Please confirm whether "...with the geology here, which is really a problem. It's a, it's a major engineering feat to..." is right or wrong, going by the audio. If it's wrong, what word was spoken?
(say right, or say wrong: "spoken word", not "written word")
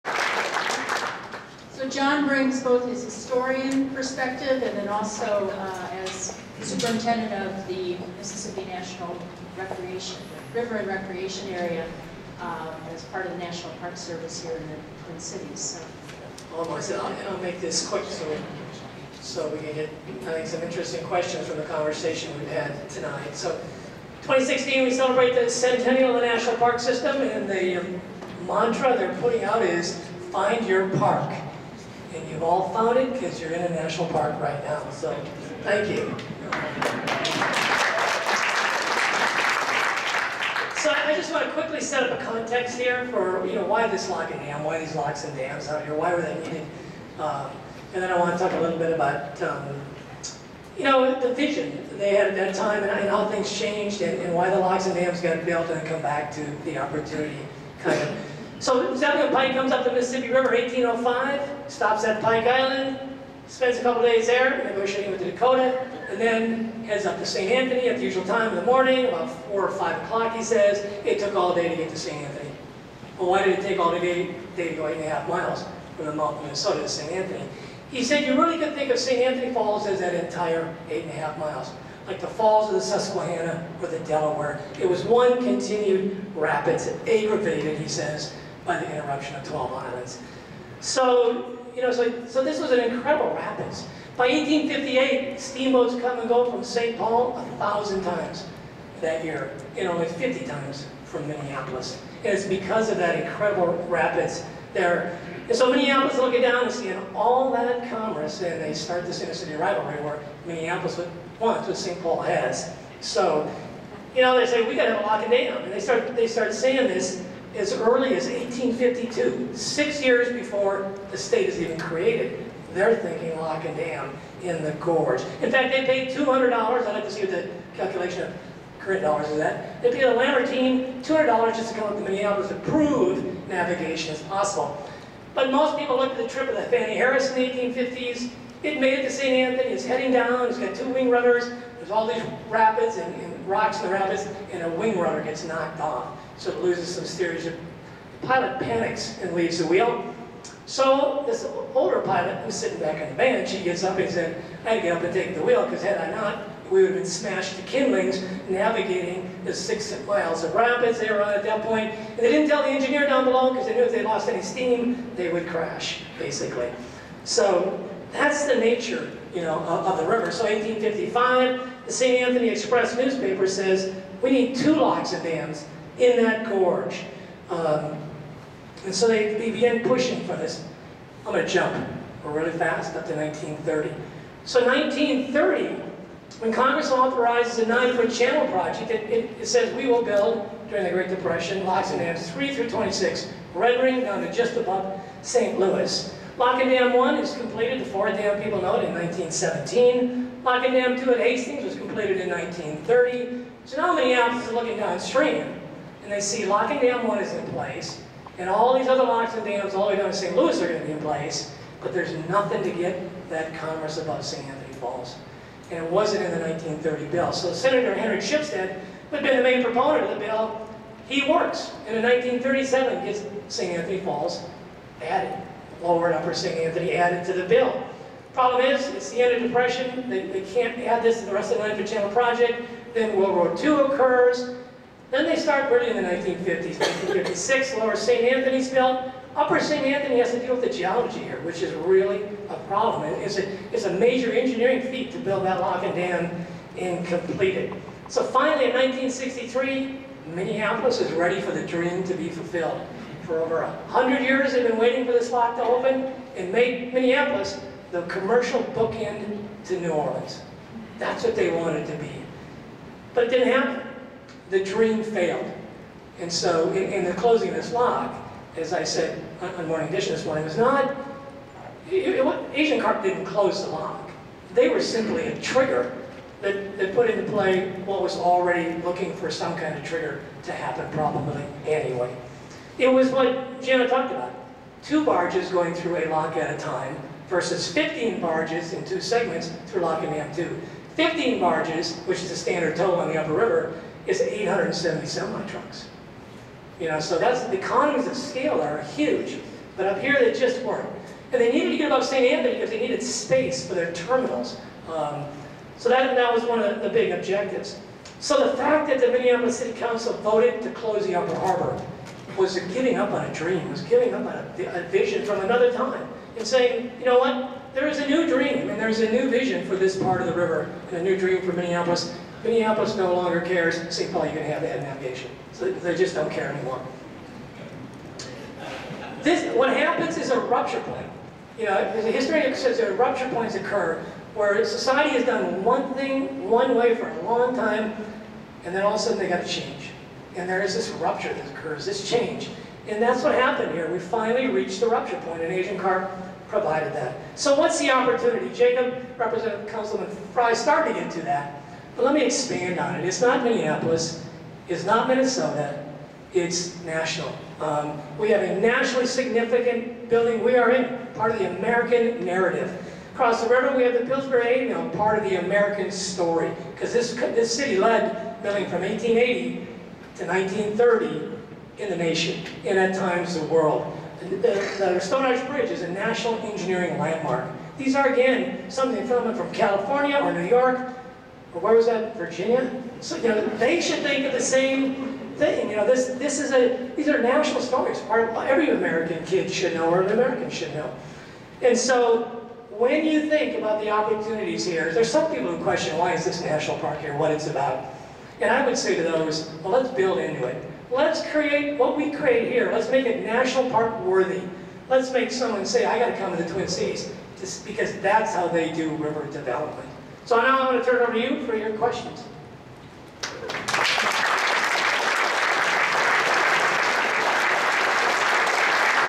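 right.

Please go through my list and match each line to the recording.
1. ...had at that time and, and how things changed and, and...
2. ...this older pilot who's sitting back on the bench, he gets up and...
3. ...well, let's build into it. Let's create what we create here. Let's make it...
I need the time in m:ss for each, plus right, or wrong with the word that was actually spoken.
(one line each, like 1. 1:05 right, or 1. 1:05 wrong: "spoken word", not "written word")
1. 0:52 right
2. 2:31 right
3. 6:39 right.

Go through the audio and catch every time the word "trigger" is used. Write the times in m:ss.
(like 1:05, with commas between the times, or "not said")
4:35, 4:39.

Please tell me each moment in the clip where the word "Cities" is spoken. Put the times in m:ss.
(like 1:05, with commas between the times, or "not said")
0:15, 6:46.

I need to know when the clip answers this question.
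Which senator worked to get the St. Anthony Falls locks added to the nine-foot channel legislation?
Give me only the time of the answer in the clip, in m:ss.
3:37.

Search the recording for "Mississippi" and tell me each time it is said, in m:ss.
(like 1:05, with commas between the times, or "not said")
0:08, 0:59.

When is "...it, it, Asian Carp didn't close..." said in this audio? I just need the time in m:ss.
4:31.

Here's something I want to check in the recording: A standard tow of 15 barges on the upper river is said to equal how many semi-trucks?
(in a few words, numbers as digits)
870.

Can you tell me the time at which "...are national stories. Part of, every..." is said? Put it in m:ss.
6:27.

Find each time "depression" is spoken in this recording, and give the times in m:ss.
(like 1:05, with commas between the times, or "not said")
3:11, 3:49.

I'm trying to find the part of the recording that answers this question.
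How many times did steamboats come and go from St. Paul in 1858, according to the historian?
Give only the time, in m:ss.
1:37.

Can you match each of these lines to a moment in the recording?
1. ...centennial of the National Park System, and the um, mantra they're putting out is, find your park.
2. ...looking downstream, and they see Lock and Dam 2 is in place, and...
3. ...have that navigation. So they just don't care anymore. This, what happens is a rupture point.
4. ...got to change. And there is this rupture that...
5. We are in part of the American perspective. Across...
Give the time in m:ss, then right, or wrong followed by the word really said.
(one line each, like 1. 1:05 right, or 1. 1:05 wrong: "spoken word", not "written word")
1. 0:25 right
2. 3:24 wrong: "1", not "2"
3. 5:24 right
4. 5:39 right
5. 6:00 wrong: "narrative", not "perspective".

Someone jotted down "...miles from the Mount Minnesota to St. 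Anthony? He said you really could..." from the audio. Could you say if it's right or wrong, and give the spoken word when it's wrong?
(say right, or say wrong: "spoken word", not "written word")
right.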